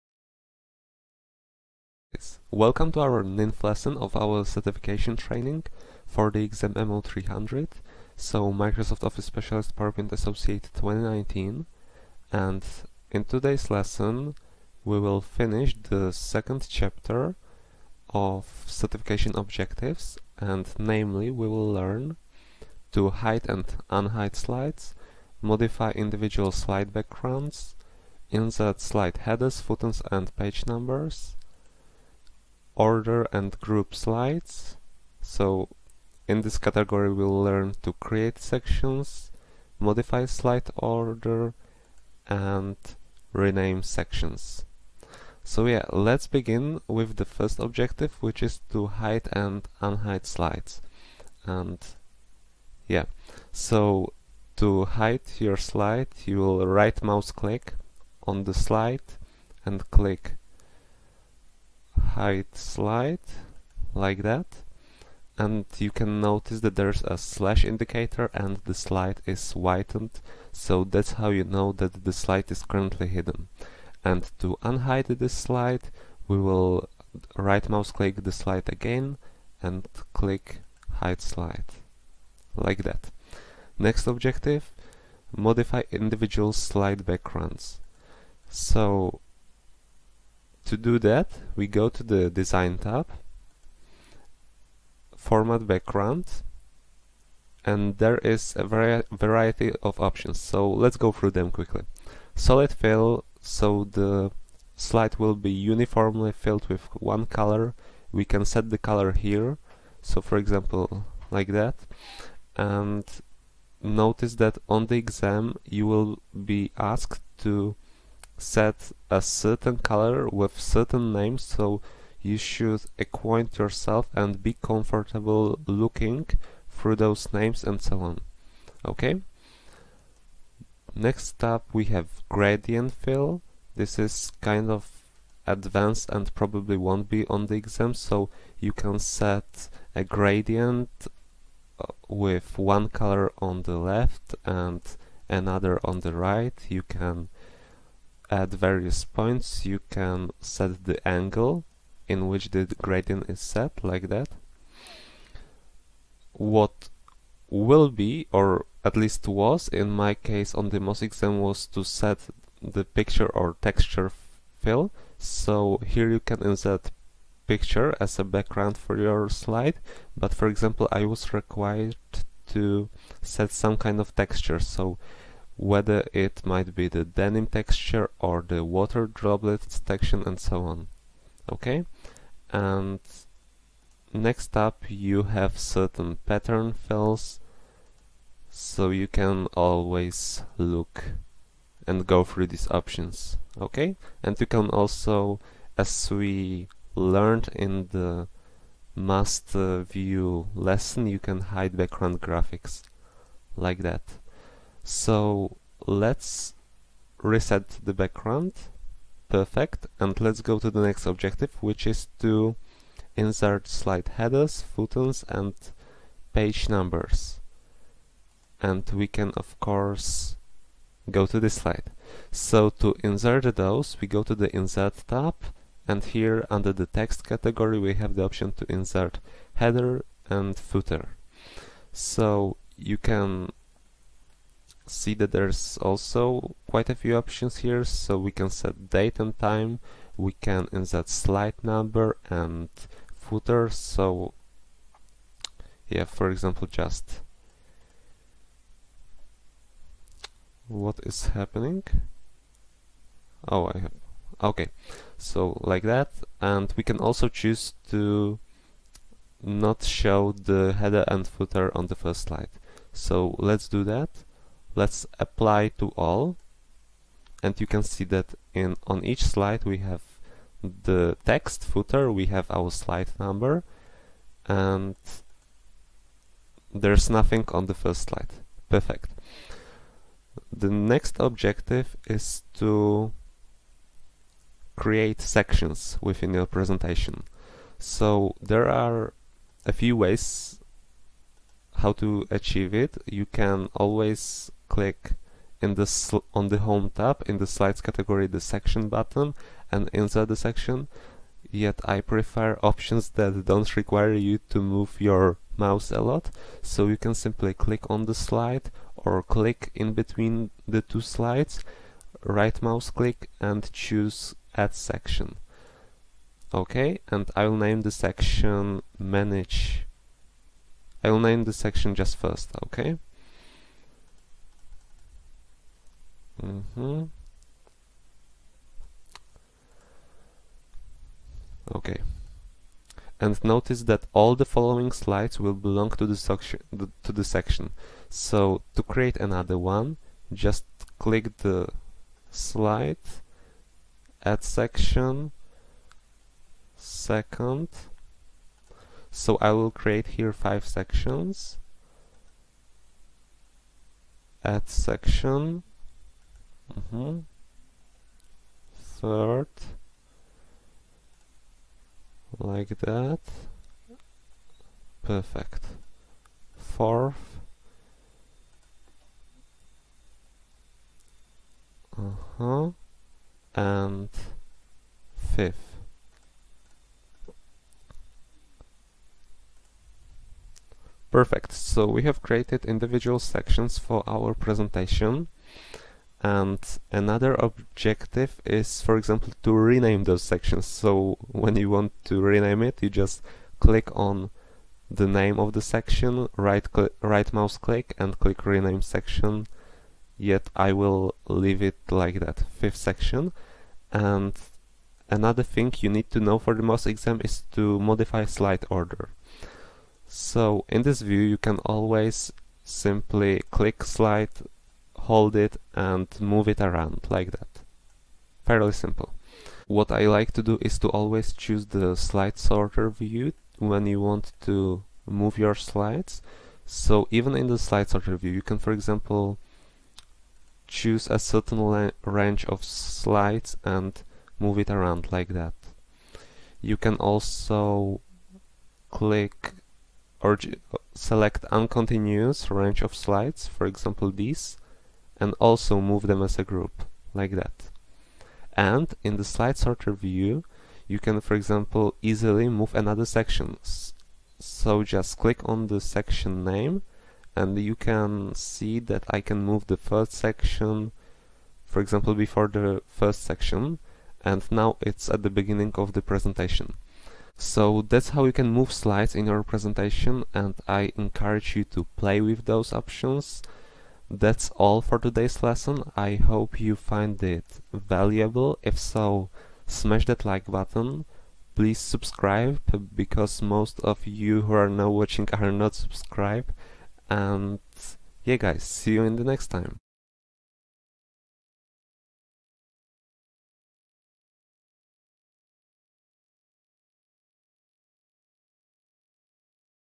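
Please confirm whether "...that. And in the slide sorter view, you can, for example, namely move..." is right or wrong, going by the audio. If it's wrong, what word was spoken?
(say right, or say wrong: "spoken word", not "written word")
wrong: "easily", not "namely".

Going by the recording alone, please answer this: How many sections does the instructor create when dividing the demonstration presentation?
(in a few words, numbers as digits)
5.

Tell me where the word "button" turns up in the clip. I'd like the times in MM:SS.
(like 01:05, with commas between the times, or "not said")
04:58, 08:00.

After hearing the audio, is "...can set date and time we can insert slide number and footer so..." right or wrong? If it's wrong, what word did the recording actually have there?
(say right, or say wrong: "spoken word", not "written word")
right.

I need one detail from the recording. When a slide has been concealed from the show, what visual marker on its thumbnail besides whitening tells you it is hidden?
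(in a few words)
slash indicator.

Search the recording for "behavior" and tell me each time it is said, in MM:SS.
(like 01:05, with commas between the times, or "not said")
not said.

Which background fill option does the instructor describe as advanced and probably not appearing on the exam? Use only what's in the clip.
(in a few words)
gradient fill.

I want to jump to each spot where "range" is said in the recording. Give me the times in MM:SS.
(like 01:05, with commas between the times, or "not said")
07:12, 07:22.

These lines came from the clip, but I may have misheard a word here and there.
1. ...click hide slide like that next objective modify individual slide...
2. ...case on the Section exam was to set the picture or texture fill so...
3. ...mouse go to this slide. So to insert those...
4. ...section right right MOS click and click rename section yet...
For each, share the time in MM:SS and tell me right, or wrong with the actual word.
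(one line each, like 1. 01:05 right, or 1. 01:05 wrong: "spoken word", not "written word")
1. 01:20 right
2. 02:40 wrong: "MOS", not "Section"
3. 03:39 wrong: "course", not "mouse"
4. 06:35 right.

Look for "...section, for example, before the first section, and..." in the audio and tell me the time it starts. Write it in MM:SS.
07:40.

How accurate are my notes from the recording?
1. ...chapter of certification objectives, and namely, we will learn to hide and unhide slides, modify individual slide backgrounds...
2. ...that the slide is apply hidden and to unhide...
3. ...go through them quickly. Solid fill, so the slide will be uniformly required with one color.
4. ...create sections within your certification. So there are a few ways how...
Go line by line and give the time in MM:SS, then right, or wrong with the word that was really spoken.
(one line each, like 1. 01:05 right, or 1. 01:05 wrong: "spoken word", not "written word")
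1. 00:16 right
2. 01:11 wrong: "currently", not "apply"
3. 01:40 wrong: "filled", not "required"
4. 04:44 wrong: "presentation", not "certification".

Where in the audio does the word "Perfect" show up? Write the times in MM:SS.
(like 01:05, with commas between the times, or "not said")
03:29, 04:38, 06:05, 06:21.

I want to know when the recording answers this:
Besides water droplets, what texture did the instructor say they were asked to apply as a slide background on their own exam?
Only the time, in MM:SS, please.
02:57.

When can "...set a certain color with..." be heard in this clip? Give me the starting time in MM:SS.
01:58.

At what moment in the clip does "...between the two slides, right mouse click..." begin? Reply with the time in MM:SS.
05:09.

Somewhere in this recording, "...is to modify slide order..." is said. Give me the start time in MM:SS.
06:47.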